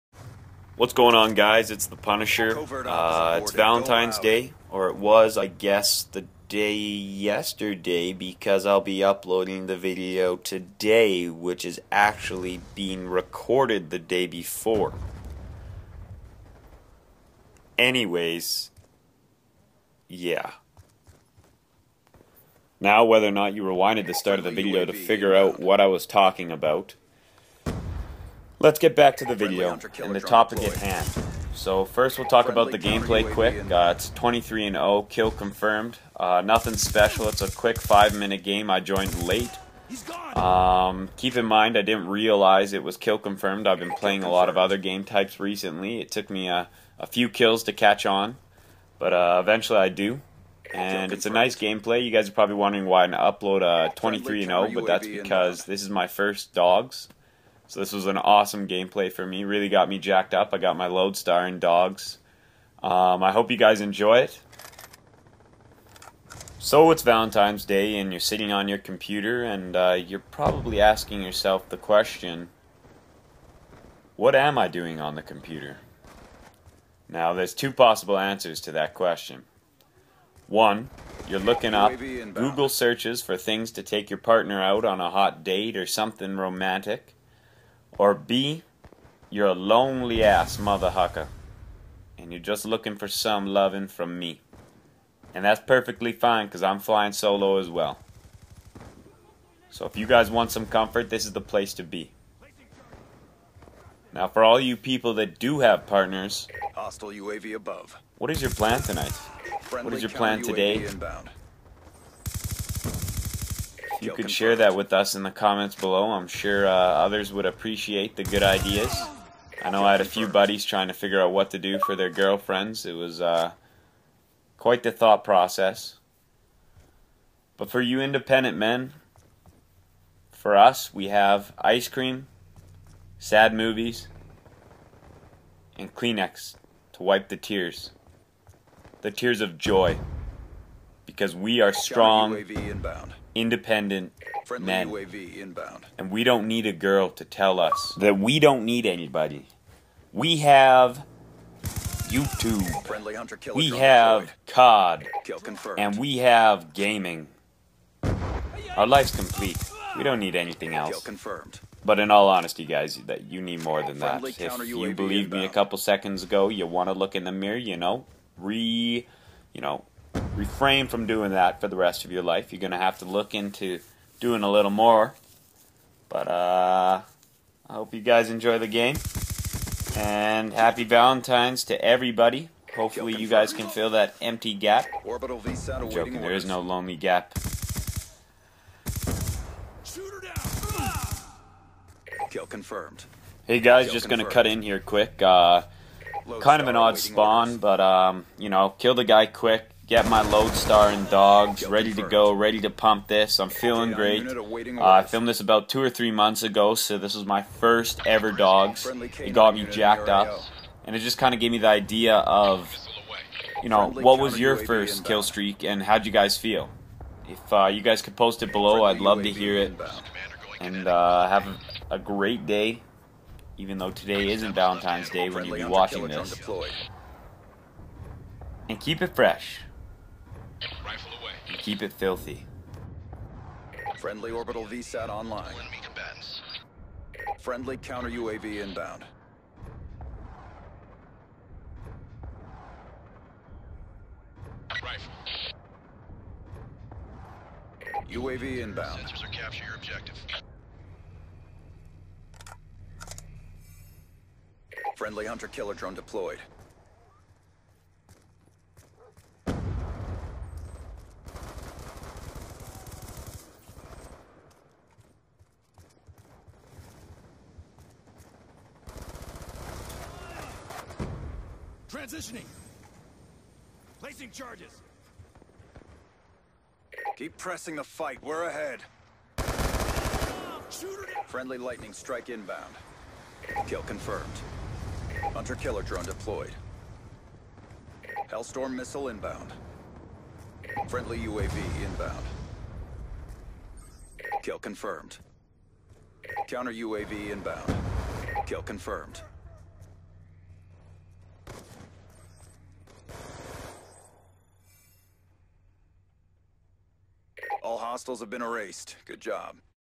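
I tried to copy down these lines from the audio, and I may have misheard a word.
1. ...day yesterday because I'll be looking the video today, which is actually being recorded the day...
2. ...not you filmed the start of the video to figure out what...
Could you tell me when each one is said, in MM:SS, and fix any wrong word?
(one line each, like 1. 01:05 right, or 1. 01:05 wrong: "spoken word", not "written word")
1. 00:06 wrong: "uploading", not "looking"
2. 00:23 wrong: "rewinded", not "filmed".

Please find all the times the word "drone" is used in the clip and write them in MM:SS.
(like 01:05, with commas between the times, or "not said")
04:15, 04:45.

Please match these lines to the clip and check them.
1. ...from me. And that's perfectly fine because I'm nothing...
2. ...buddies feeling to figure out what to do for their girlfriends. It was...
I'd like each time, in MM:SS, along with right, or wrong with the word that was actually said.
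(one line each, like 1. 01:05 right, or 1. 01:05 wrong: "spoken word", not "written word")
1. 01:33 wrong: "flying", not "nothing"
2. 02:00 wrong: "trying", not "feeling".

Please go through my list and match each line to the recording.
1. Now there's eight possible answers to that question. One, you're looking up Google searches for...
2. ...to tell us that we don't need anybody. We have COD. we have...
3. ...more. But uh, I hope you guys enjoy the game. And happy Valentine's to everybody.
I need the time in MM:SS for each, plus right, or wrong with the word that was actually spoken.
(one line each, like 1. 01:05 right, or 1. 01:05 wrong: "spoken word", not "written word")
1. 01:17 wrong: "two", not "eight"
2. 02:27 wrong: "YouTube", not "COD"
3. 02:54 right.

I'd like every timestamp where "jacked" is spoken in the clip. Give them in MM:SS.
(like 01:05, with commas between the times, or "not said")
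00:59, 03:29.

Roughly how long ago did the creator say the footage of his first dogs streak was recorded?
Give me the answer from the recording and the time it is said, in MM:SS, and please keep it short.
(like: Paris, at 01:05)
two or three months, at 03:25.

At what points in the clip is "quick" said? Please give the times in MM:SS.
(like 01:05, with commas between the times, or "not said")
00:33, 00:37, 03:14, 03:19.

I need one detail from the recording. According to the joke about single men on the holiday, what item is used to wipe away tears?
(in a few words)
Kleenex.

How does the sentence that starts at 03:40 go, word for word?
And uh, have a great day, even though today isn't Valentine's Day when you are watching this.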